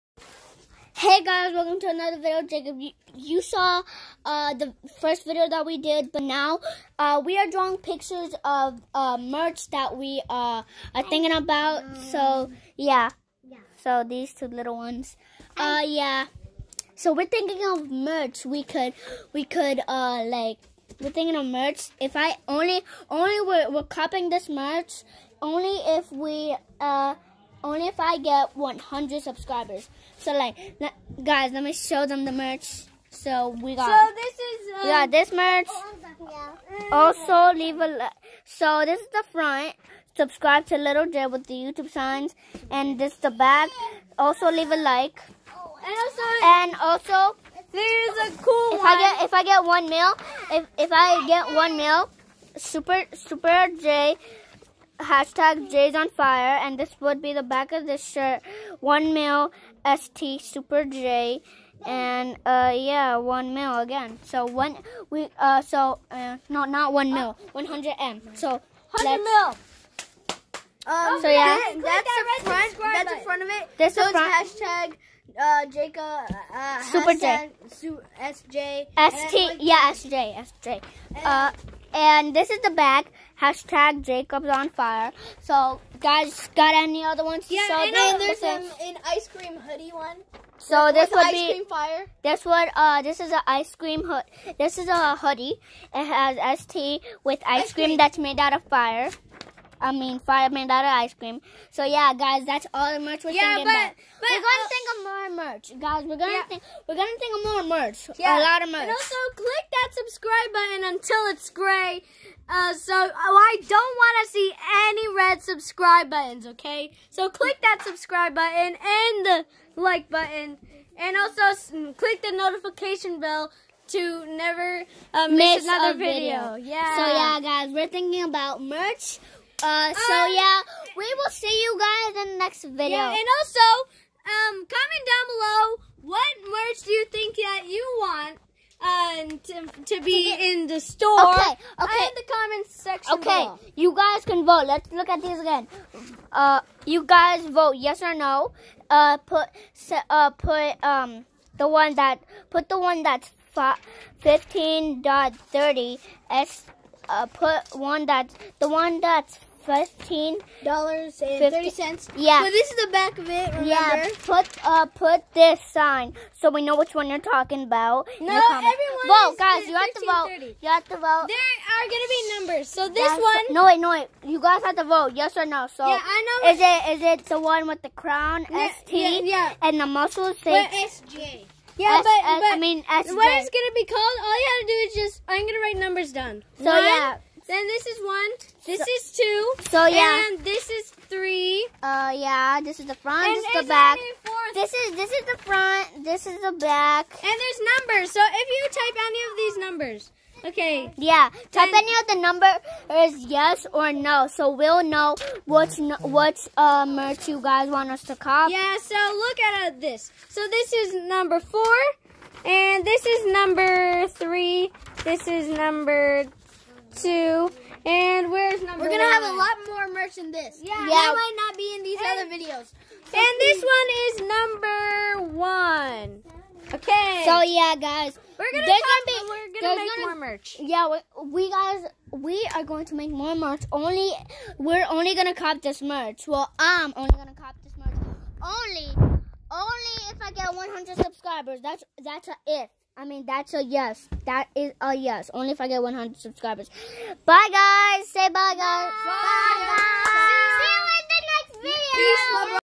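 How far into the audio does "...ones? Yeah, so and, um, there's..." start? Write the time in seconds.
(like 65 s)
87 s.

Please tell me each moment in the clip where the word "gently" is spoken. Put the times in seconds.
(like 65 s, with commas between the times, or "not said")
not said.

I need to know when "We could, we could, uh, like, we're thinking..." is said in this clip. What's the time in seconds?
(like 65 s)
18 s.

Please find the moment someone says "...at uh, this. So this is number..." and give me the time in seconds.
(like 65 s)
209 s.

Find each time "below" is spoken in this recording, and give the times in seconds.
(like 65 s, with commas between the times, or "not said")
135 s, 143 s.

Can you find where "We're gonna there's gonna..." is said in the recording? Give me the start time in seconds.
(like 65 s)
228 s.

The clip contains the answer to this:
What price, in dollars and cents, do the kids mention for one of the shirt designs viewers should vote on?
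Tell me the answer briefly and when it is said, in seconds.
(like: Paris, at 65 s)
$15.30, at 159 s.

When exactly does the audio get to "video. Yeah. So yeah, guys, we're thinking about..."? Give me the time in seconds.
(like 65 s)
126 s.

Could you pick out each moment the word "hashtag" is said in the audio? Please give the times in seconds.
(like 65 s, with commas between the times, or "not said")
55 s, 74 s, 83 s.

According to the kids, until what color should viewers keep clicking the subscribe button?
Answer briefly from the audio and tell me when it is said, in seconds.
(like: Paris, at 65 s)
gray, at 111 s.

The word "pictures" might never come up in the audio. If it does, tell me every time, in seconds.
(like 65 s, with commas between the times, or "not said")
7 s.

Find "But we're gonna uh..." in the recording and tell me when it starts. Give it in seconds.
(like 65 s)
104 s.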